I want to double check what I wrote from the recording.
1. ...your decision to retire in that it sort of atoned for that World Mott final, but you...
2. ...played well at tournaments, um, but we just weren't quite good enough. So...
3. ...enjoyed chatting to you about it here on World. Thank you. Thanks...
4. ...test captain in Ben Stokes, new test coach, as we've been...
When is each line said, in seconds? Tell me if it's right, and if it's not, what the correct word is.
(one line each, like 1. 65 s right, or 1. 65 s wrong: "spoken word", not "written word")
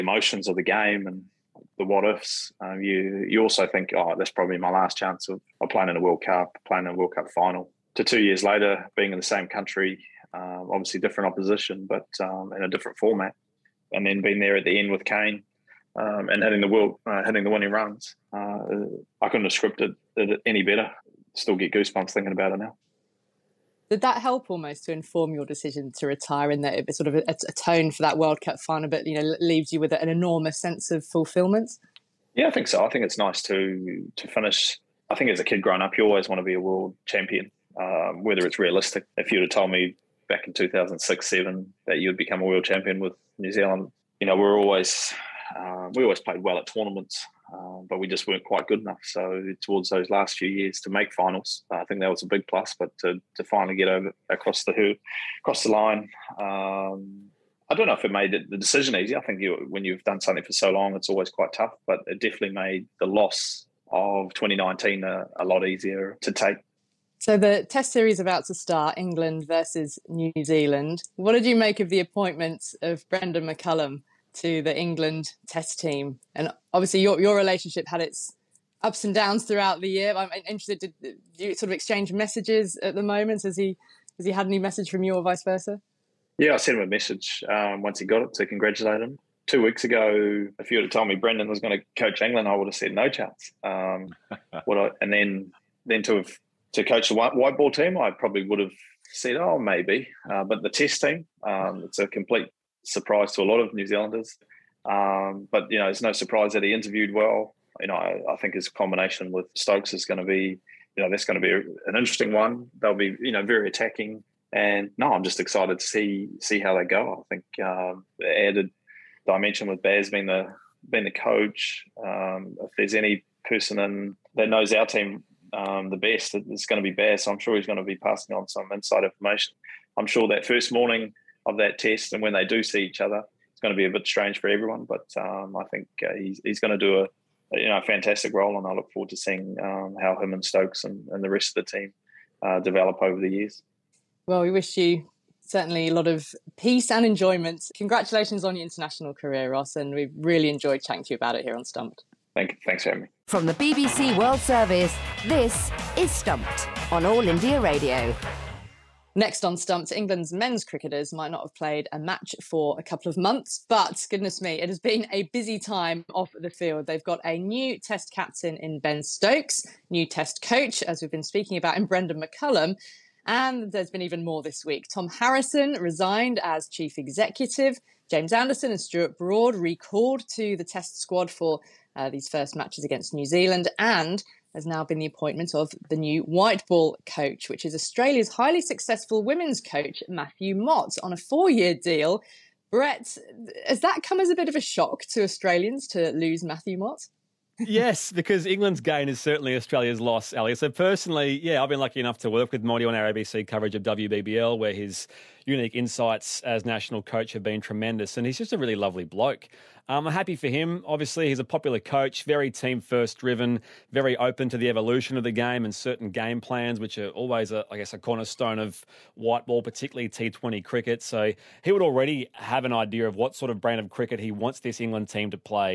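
1. 25 s wrong: "Cup", not "Mott"
2. 46 s right
3. 150 s wrong: "Stumped", not "World"
4. 167 s right.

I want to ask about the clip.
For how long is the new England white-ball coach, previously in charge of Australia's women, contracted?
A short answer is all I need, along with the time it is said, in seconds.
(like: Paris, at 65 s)
4 years, at 191 s.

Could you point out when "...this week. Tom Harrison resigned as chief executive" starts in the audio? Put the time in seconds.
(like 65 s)
174 s.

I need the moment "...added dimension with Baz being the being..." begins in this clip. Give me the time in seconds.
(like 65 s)
118 s.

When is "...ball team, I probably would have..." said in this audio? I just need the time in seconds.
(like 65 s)
97 s.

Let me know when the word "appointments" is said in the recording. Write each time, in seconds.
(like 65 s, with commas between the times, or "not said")
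71 s, 185 s.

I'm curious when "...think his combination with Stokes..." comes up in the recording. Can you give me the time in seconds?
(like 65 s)
108 s.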